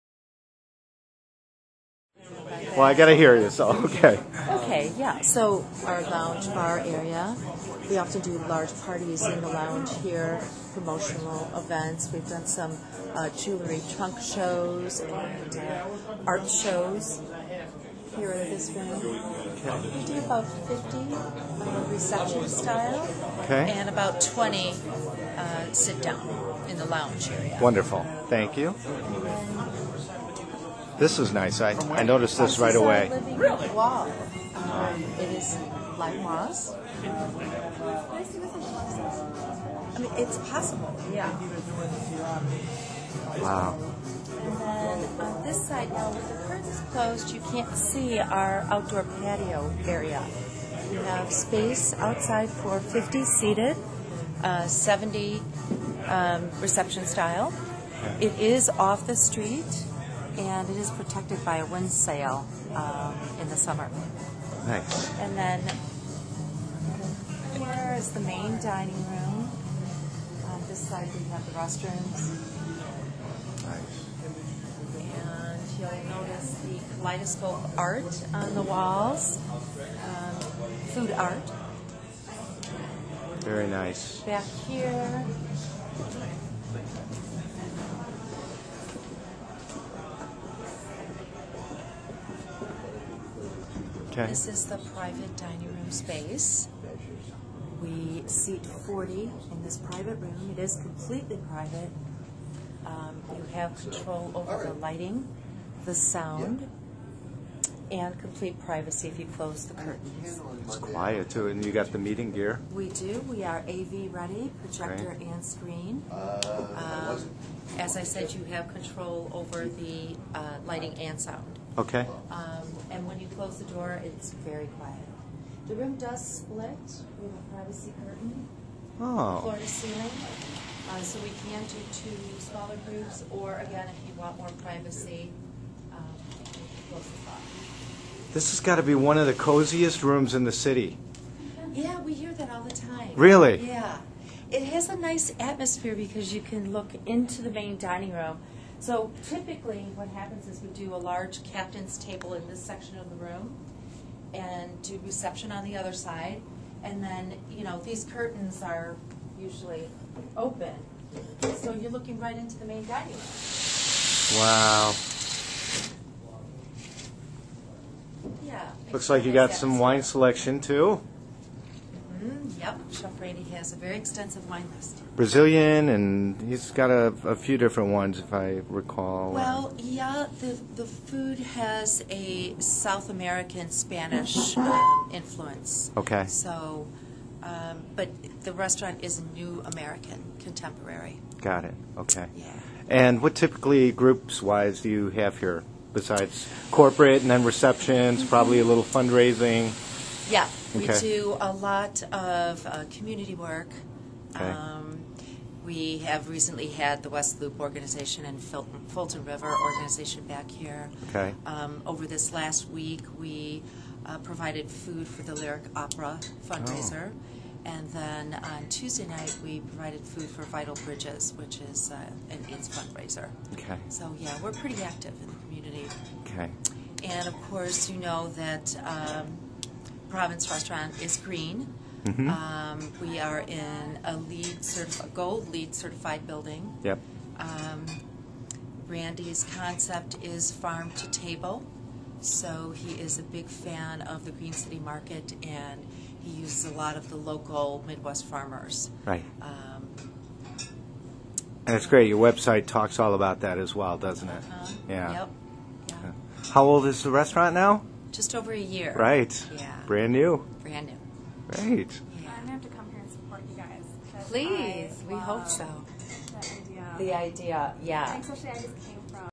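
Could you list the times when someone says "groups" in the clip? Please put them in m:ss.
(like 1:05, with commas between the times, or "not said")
2:12, 3:13.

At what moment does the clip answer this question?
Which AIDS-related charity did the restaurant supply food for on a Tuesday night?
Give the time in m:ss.
3:40.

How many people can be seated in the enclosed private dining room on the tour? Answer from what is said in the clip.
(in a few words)
40.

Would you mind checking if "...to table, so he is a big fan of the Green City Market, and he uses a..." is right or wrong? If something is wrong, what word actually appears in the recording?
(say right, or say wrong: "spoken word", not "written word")
right.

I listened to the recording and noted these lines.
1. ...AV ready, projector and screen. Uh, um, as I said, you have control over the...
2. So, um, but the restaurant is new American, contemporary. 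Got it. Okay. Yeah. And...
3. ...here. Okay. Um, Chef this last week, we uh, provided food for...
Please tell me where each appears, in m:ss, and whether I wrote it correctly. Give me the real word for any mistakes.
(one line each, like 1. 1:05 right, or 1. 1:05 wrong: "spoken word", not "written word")
1. 1:53 right
2. 3:06 right
3. 3:30 wrong: "Over", not "Chef".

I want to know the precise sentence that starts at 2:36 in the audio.
And then, you know, these curtains are usually open.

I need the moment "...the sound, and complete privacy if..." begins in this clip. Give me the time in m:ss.
1:45.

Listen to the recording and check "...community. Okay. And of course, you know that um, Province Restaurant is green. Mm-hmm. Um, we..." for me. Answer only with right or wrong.
right.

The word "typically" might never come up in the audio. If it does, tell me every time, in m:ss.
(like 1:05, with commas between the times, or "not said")
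2:29, 3:13.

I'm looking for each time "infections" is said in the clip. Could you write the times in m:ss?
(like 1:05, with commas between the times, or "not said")
not said.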